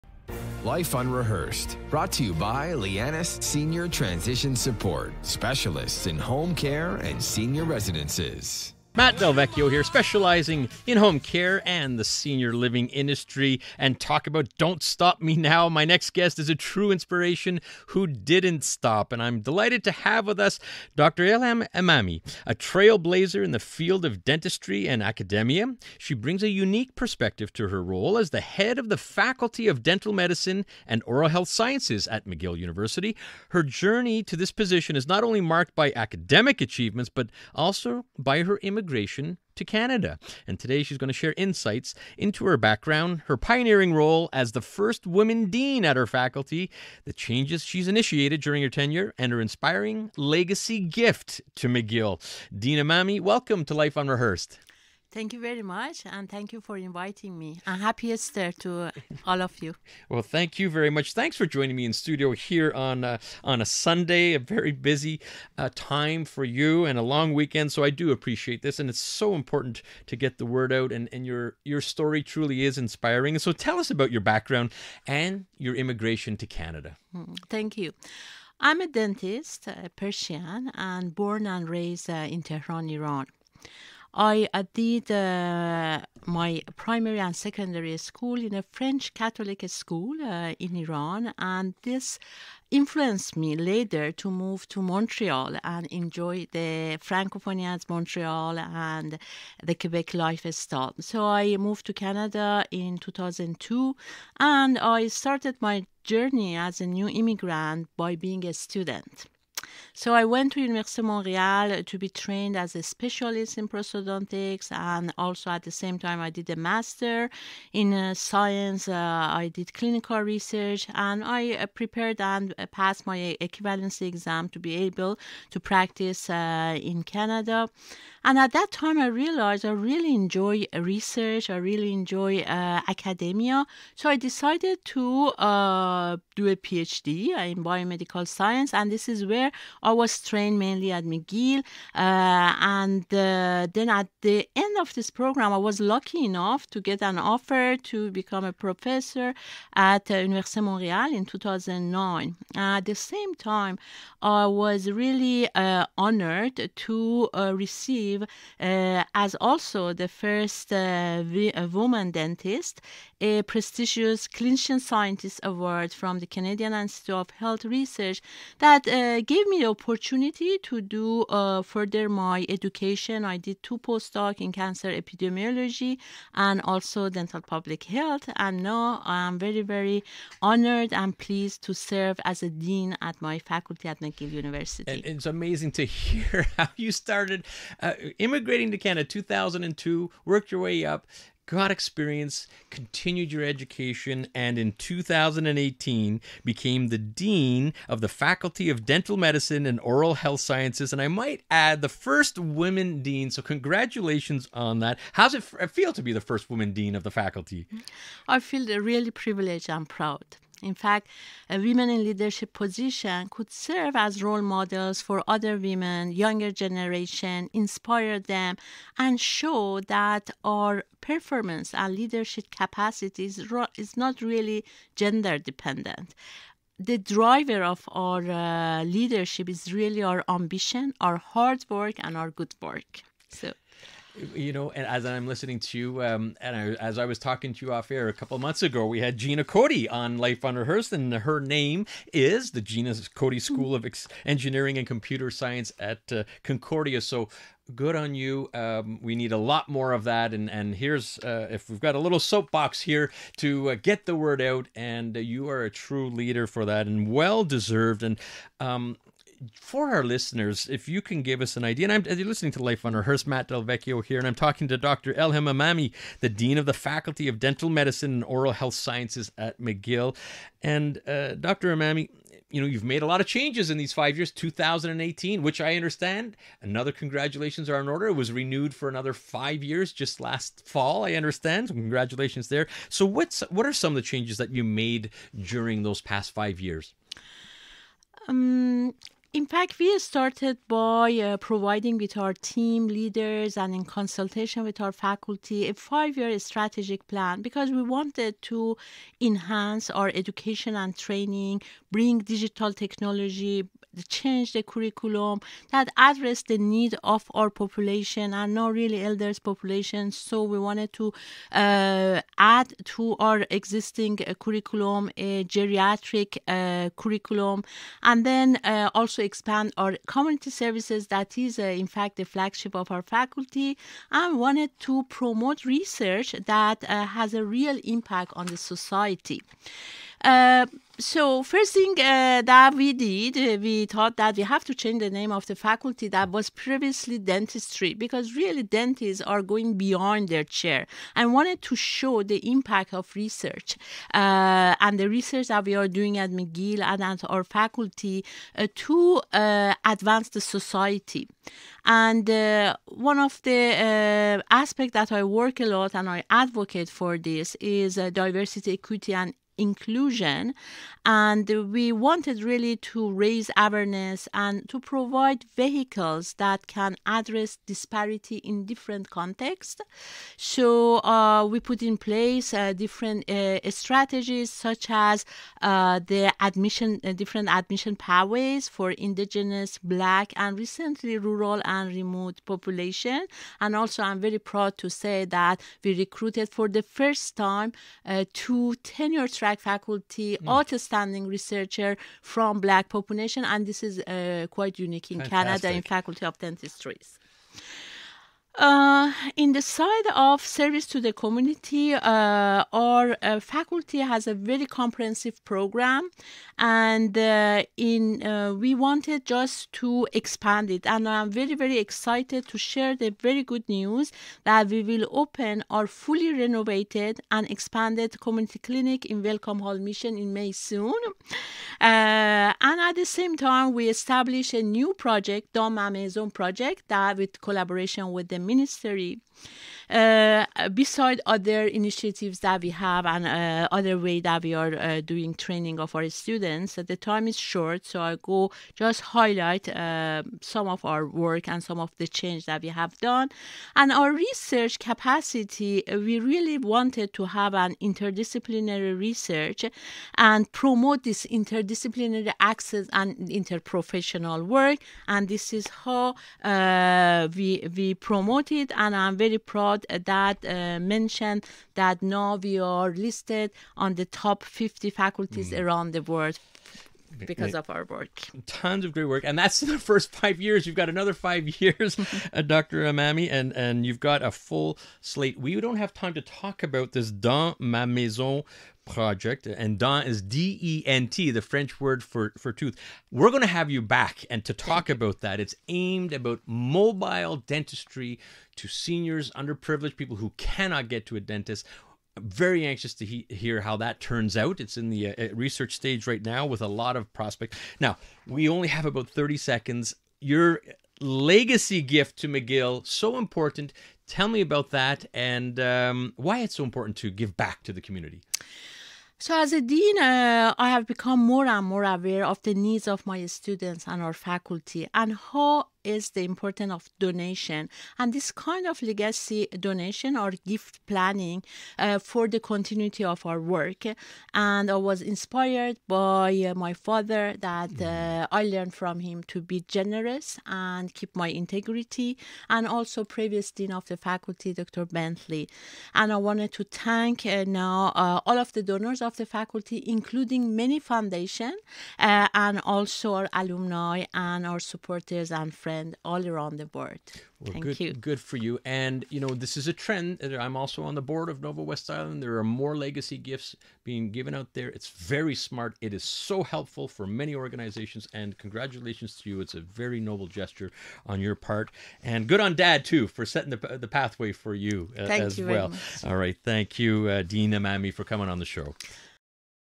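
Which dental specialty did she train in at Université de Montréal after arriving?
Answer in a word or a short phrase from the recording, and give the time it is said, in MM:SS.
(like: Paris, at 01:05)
Prosthodontics, at 01:53.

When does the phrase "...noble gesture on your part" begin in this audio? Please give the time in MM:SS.
09:19.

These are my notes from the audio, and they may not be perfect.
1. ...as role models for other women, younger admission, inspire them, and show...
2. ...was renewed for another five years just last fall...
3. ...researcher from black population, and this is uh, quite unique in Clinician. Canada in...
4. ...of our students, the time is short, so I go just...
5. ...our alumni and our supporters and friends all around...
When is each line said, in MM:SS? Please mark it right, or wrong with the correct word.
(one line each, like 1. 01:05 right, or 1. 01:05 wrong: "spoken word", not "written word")
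1. 03:33 wrong: "generation", not "admission"
2. 04:38 right
3. 06:31 wrong: "Fantastic", not "Clinician"
4. 07:15 right
5. 09:03 right.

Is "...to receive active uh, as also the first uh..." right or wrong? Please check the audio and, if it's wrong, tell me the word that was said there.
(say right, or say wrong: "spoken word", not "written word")
right.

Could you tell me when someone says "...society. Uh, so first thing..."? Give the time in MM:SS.
05:28.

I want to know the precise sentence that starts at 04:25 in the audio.
Elham Emami, the Dean of the Faculty of Dental Medicine and Oral Health Sciences at McGill.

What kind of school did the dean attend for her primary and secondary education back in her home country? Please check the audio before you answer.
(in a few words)
French Catholic school.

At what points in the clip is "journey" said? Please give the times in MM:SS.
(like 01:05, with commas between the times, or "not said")
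00:33, 01:46.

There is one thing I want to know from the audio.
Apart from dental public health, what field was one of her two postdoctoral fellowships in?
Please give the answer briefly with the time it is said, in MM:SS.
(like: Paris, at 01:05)
Cancer epidemiology, at 02:54.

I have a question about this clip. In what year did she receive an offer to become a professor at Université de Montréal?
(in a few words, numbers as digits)
2009.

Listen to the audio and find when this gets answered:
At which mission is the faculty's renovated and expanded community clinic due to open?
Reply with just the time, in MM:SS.
06:59.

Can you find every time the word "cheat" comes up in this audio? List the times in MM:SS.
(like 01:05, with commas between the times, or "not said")
not said.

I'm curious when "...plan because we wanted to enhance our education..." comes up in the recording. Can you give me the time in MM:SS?
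04:57.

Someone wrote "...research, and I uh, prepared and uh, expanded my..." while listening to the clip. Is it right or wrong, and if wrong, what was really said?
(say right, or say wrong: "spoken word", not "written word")
wrong: "passed", not "expanded".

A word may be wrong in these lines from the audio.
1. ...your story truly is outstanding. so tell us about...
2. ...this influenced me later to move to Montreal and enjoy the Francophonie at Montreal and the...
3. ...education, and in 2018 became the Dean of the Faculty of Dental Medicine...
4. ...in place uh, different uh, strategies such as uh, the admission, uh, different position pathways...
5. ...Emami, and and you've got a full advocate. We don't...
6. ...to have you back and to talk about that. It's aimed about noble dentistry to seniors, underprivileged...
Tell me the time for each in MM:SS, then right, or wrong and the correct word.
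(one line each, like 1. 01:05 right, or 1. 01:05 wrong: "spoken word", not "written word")
1. 01:11 wrong: "inspiring", not "outstanding"
2. 01:31 right
3. 03:13 right
4. 06:11 wrong: "admission", not "position"
5. 07:52 wrong: "slate", not "advocate"
6. 08:03 wrong: "mobile", not "noble".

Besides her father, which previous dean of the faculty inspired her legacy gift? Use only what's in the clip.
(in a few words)
Dr. Bentley.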